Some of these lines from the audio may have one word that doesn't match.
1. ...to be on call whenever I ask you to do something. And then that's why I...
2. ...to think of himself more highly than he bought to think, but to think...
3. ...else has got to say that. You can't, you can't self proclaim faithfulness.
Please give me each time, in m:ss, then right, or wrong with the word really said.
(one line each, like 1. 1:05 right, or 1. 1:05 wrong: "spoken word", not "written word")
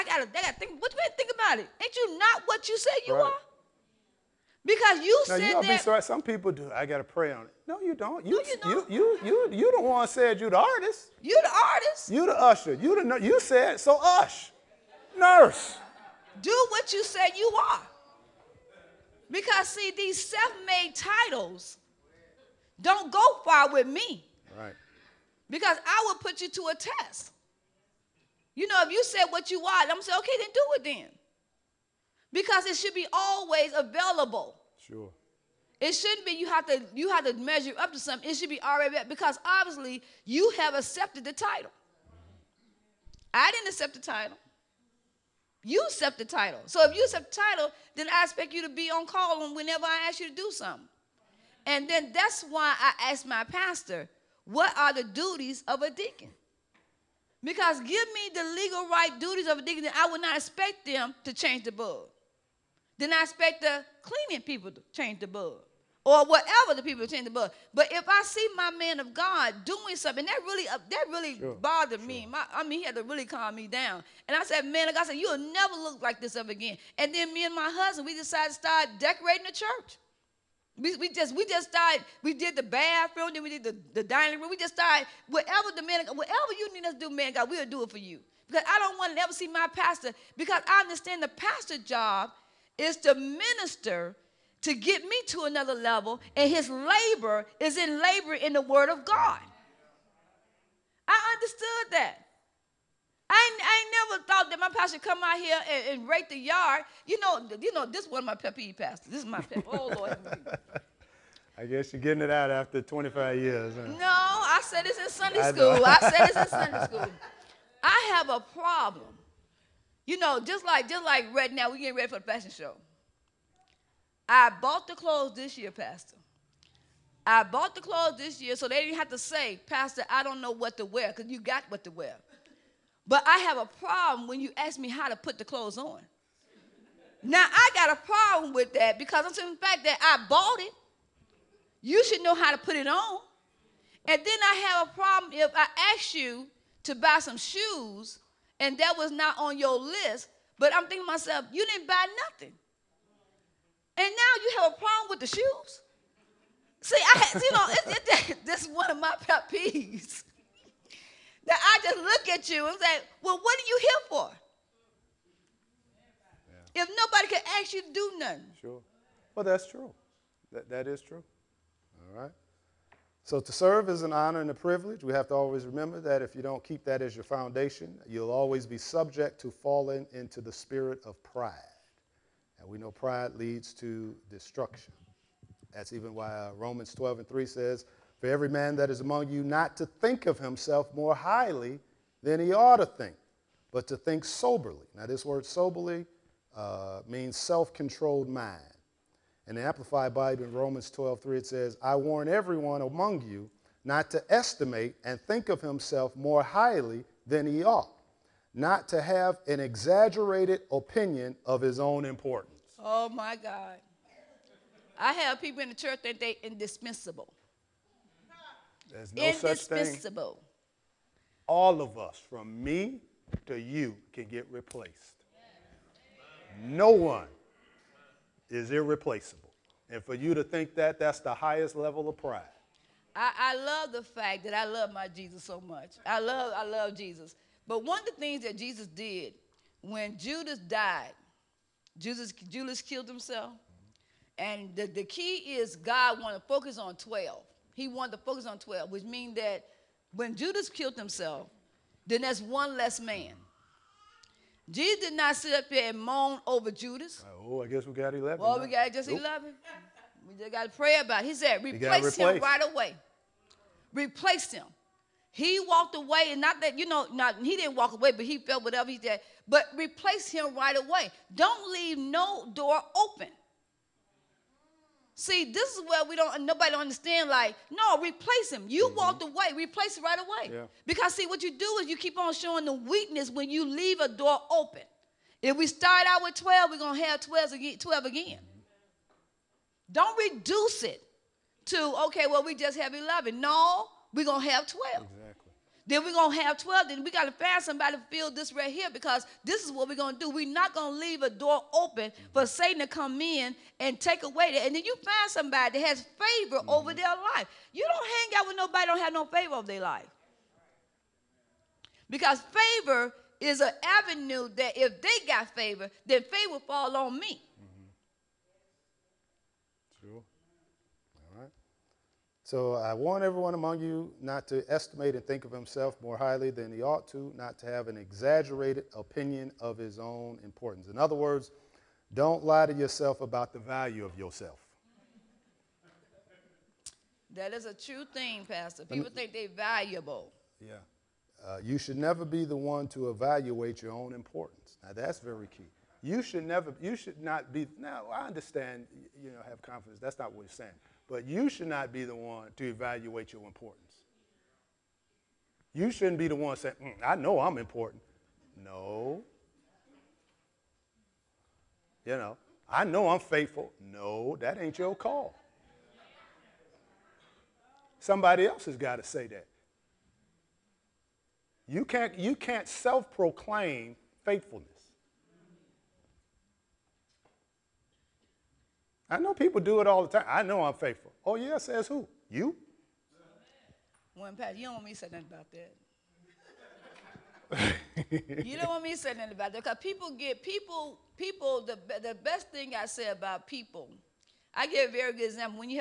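1. 0:48 right
2. 3:09 wrong: "ought", not "bought"
3. 6:08 right.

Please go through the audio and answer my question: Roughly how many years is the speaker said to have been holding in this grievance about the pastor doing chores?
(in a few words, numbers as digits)
25.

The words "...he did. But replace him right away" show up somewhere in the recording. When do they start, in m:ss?
4:28.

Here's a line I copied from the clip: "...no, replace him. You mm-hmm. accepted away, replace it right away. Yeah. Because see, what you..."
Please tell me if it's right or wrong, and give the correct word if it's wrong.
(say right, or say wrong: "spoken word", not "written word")
wrong: "walked", not "accepted".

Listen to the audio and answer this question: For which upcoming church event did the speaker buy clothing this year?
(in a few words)
Fashion show.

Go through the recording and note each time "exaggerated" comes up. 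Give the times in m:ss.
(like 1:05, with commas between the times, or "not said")
3:29, 5:27.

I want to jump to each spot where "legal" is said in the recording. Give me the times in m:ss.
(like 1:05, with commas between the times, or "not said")
0:58.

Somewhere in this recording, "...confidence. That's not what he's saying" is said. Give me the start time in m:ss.
5:49.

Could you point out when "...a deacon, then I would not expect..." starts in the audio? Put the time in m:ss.
0:59.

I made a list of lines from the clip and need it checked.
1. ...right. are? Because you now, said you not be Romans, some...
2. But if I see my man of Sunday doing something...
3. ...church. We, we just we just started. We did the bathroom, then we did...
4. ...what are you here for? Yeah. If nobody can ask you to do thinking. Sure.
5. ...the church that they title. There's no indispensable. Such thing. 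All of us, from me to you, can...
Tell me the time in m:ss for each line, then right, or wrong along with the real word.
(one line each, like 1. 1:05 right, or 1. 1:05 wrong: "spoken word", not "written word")
1. 0:03 wrong: "Sorry", not "Romans"
2. 1:07 wrong: "God", not "Sunday"
3. 1:19 right
4. 2:43 wrong: "nothing", not "thinking"
5. 3:35 wrong: "indispensable", not "title".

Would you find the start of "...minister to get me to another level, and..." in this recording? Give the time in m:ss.
1:33.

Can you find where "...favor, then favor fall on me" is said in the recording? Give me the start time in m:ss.
5:15.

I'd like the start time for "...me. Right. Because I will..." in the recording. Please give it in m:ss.
0:23.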